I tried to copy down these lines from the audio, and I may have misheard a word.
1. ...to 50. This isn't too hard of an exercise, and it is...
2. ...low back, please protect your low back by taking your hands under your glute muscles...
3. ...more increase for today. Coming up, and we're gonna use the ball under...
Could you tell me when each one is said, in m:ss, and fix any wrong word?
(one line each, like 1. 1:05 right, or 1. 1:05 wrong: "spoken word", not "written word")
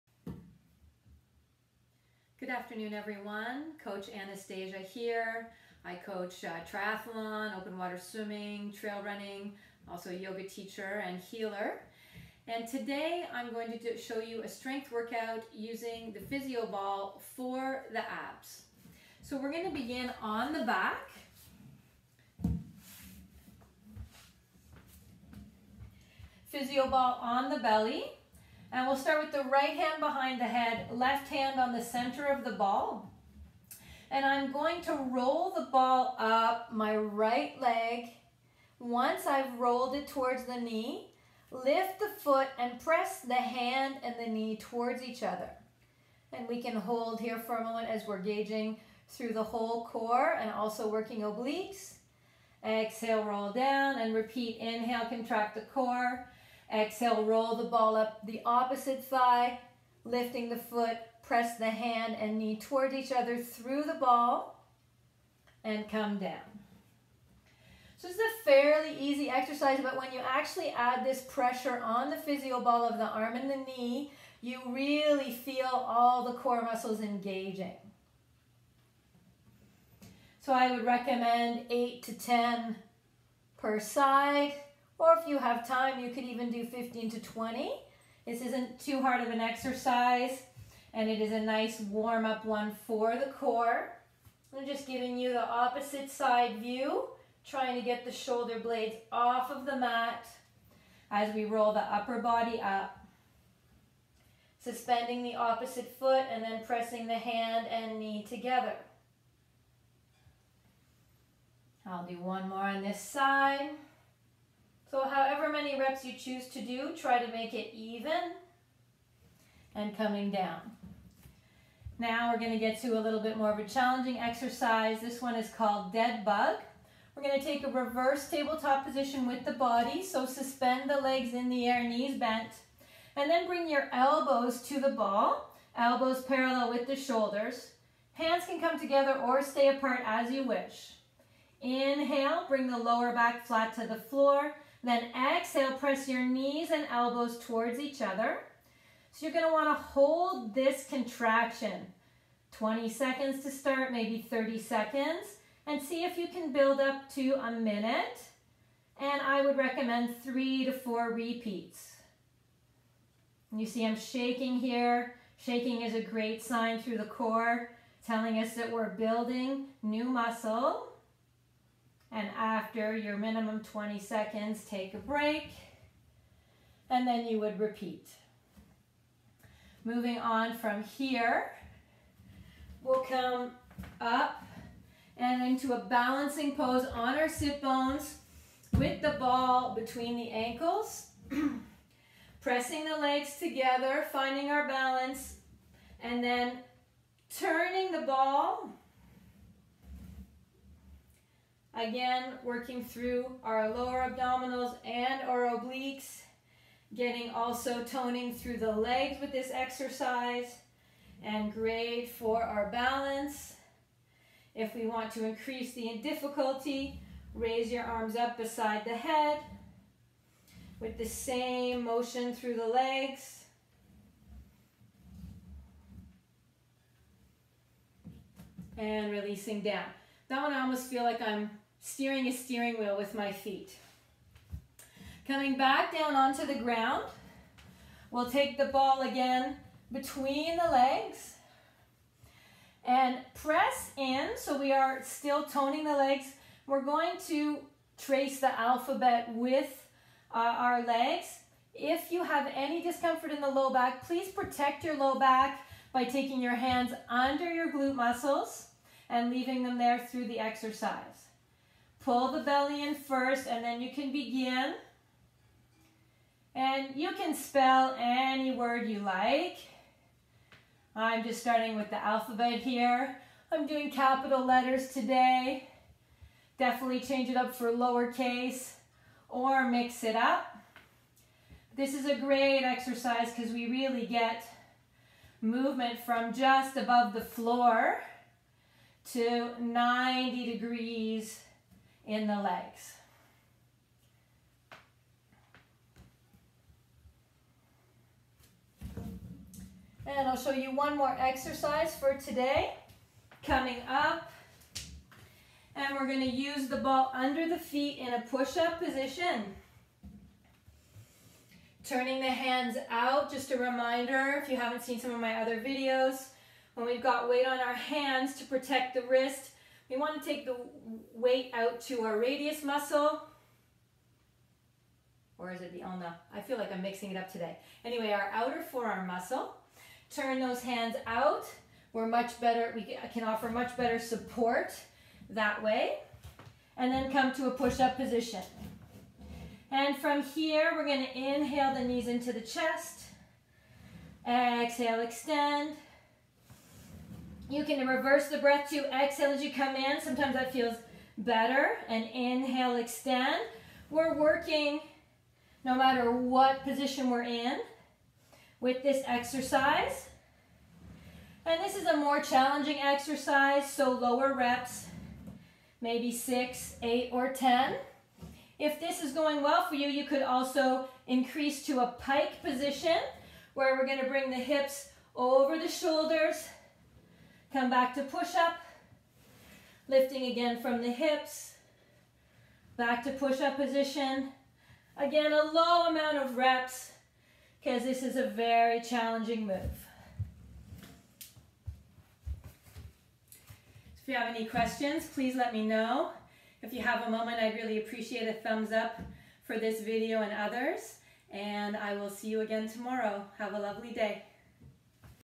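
1. 1:27 wrong: "20", not "50"
2. 4:13 right
3. 5:00 wrong: "exercise", not "increase".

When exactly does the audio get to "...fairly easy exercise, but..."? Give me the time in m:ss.
1:08.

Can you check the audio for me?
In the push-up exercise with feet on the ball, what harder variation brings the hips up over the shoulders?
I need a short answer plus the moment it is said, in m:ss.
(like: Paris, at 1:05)
Pike position, at 6:11.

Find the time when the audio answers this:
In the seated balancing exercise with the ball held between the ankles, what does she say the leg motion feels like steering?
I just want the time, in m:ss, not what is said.
3:52.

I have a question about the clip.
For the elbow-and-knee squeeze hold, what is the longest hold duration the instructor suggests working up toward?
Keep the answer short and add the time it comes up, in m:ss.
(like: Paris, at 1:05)
A minute, at 2:37.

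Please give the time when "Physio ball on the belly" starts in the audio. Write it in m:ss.
0:26.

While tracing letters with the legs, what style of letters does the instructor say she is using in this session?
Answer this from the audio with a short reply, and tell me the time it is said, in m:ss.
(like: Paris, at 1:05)
Capital letters, at 4:33.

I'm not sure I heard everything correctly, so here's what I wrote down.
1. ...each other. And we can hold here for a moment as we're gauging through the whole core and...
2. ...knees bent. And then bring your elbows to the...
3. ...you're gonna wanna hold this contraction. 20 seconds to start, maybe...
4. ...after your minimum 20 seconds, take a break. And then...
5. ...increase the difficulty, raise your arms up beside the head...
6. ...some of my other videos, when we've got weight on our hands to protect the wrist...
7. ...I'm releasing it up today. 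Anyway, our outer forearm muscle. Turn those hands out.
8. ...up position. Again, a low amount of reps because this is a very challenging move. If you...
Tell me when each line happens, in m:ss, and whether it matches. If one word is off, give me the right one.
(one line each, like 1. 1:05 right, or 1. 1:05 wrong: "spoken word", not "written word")
1. 0:45 right
2. 2:11 right
3. 2:29 right
4. 2:52 right
5. 3:35 right
6. 5:14 right
7. 5:26 wrong: "mixing", not "releasing"
8. 6:23 right.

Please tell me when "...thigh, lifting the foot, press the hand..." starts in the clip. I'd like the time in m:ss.
0:59.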